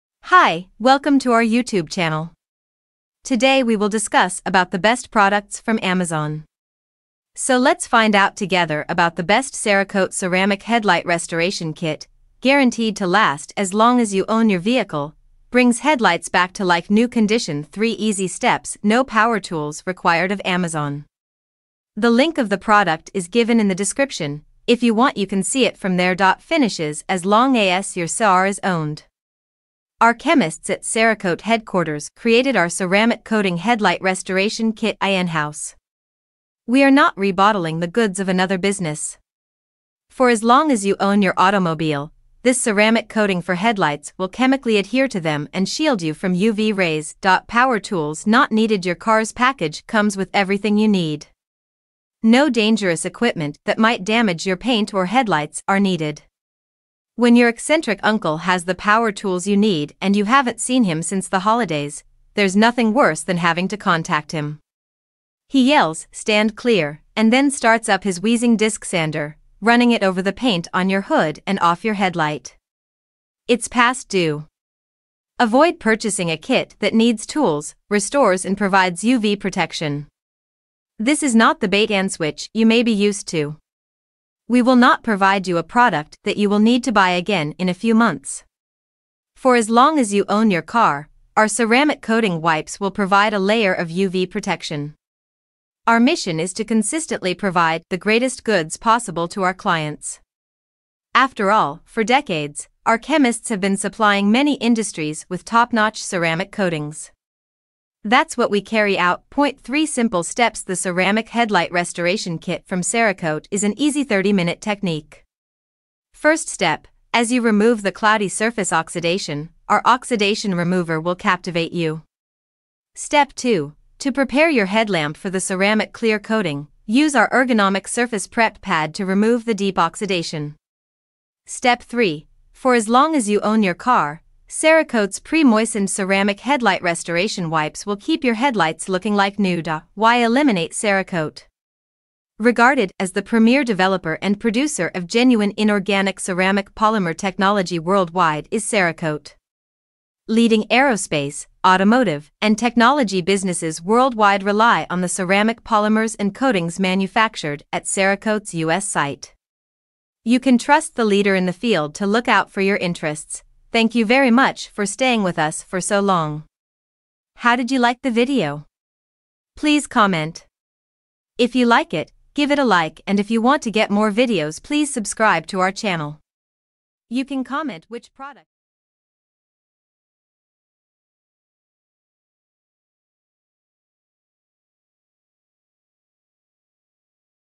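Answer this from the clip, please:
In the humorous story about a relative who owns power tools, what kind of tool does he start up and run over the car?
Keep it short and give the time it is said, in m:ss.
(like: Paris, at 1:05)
disc sander, at 1:08.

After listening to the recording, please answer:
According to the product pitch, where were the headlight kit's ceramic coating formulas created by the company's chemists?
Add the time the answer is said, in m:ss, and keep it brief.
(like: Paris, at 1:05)
Cerakote headquarters, at 0:30.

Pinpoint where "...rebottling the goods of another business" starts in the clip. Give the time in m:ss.
0:37.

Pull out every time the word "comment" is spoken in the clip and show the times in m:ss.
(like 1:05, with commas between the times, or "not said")
2:49, 2:57.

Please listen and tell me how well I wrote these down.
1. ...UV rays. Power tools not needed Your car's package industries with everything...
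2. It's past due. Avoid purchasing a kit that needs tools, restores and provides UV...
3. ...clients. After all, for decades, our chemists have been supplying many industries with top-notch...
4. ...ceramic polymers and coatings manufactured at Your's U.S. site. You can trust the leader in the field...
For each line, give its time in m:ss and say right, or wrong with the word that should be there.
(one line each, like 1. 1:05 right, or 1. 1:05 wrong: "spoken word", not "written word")
1. 0:46 wrong: "comes", not "industries"
2. 1:13 right
3. 1:39 right
4. 2:35 wrong: "Cerakote", not "Your".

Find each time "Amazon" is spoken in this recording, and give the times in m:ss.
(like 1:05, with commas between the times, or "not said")
0:05, 0:20.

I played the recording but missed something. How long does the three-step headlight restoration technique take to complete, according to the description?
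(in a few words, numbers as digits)
30 minutes.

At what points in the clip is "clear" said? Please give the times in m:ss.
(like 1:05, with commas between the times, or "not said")
1:06, 2:05.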